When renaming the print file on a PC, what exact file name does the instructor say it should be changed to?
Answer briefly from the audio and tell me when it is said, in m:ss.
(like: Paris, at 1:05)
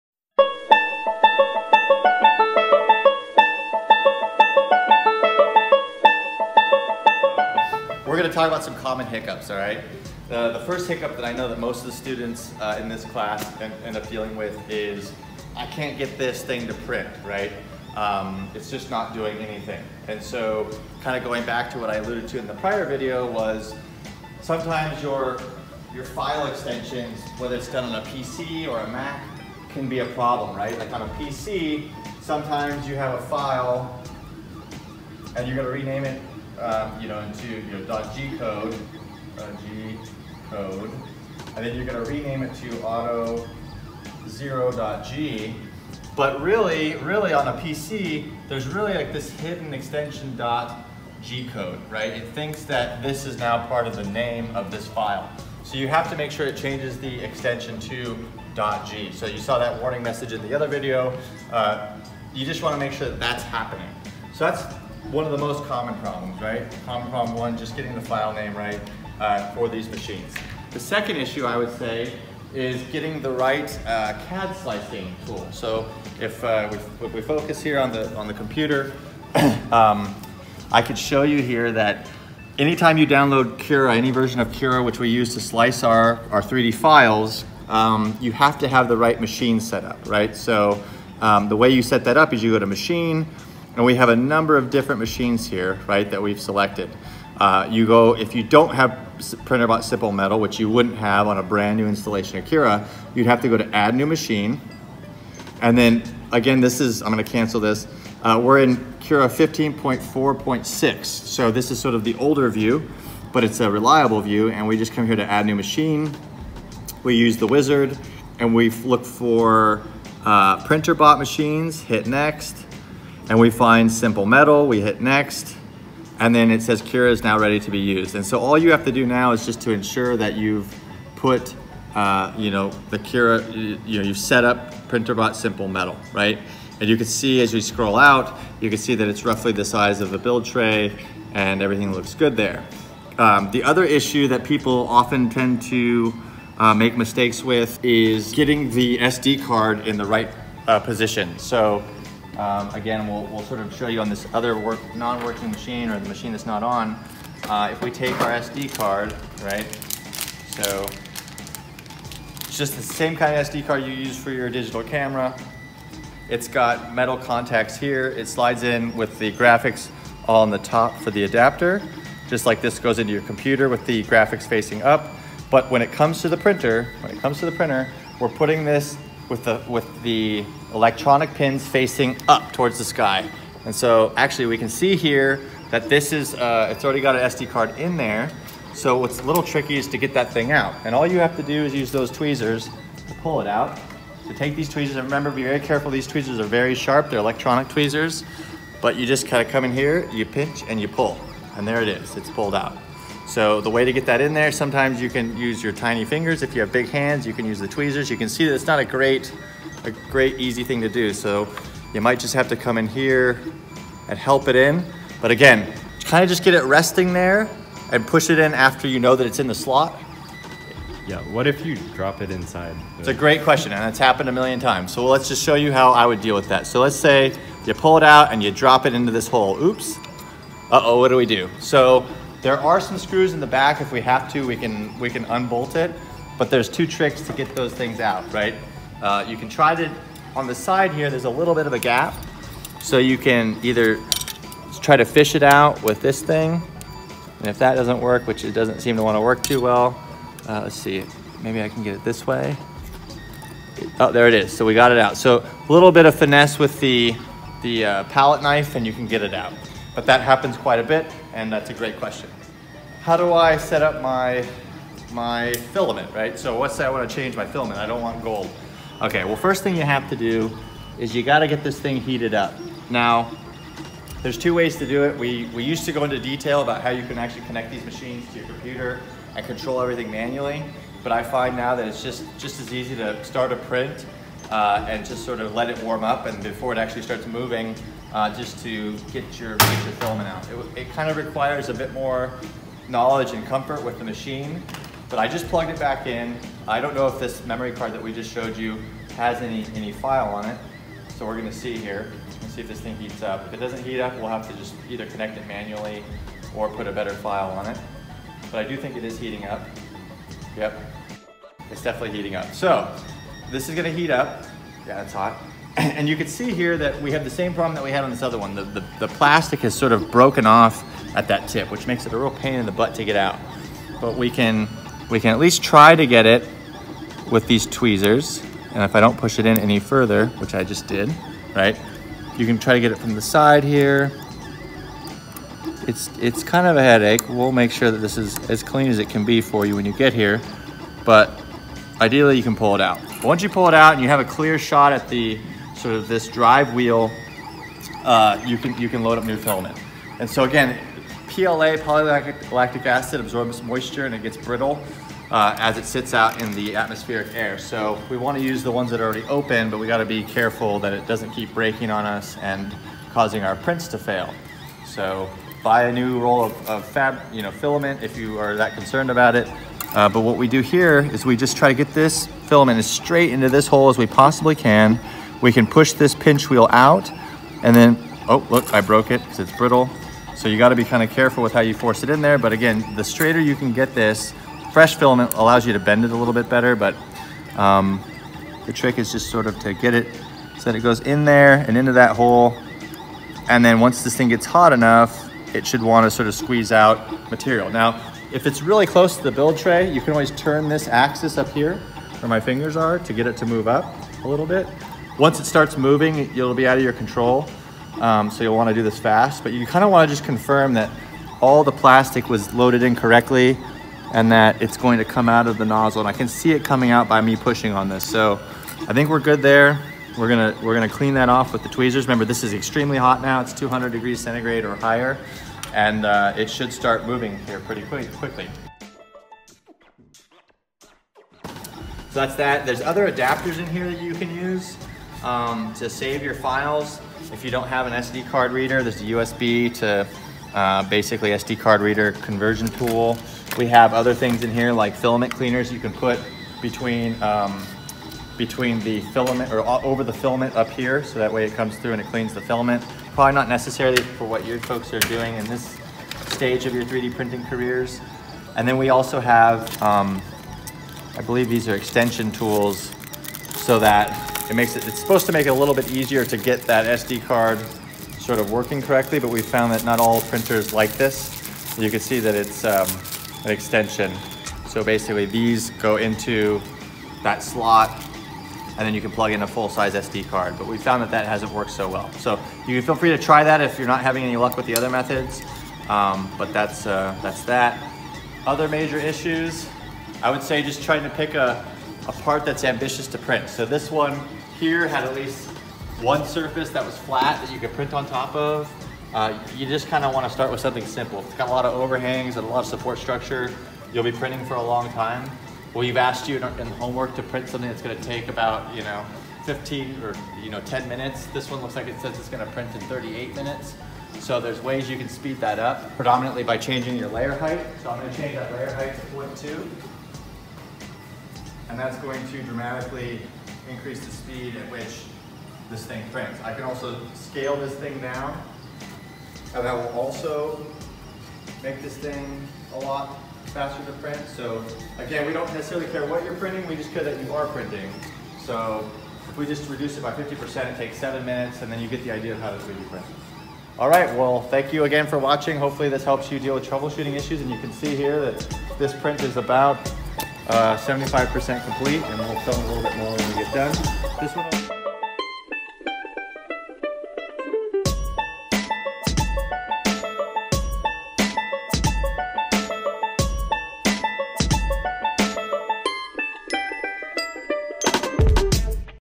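auto0.g, at 0:42.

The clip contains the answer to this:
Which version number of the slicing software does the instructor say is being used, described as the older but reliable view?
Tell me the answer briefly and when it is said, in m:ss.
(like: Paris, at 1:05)
15.4.6, at 1:49.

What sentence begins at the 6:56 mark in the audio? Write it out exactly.
And I can see it coming out by me pushing on this.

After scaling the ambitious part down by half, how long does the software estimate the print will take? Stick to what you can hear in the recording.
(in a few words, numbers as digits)
7 minutes.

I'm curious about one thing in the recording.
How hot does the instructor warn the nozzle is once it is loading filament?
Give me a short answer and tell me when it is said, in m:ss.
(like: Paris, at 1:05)
200 degrees centigrade, at 7:03.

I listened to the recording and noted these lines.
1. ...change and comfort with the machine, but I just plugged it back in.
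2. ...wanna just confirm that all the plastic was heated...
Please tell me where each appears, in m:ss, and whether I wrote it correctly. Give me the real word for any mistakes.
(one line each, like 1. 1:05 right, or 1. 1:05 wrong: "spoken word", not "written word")
1. 4:52 wrong: "knowledge", not "change"
2. 6:49 wrong: "loaded", not "heated".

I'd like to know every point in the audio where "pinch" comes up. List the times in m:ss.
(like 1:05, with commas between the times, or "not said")
3:20, 6:16.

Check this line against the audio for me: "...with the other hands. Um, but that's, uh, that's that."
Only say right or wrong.
wrong.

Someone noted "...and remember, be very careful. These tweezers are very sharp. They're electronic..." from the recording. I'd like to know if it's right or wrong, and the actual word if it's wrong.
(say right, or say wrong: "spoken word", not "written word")
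right.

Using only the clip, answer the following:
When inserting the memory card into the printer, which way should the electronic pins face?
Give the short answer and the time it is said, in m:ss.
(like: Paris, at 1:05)
up towards the sky, at 3:01.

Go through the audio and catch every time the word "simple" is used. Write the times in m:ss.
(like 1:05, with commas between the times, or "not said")
1:39, 2:03, 2:15, 8:20.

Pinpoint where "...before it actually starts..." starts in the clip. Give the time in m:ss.
4:46.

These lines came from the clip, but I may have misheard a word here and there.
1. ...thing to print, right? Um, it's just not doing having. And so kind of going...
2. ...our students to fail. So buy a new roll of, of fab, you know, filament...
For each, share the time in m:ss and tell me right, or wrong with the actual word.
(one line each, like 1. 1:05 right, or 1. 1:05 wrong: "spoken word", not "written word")
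1. 0:16 wrong: "anything", not "having"
2. 6:03 wrong: "prints", not "students".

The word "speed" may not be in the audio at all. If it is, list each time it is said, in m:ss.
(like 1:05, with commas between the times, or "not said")
8:35, 8:44.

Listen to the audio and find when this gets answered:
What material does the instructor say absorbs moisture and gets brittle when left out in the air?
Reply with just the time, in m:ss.
5:51.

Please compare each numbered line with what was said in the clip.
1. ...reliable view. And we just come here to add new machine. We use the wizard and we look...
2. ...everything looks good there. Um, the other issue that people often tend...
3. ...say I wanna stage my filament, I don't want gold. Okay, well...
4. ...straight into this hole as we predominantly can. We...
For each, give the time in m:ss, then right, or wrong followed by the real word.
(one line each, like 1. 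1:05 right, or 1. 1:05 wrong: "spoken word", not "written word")
1. 1:53 right
2. 2:21 right
3. 4:26 wrong: "change", not "stage"
4. 6:12 wrong: "possibly", not "predominantly".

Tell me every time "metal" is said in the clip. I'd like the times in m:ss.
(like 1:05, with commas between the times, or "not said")
1:40, 2:04, 2:15, 2:46.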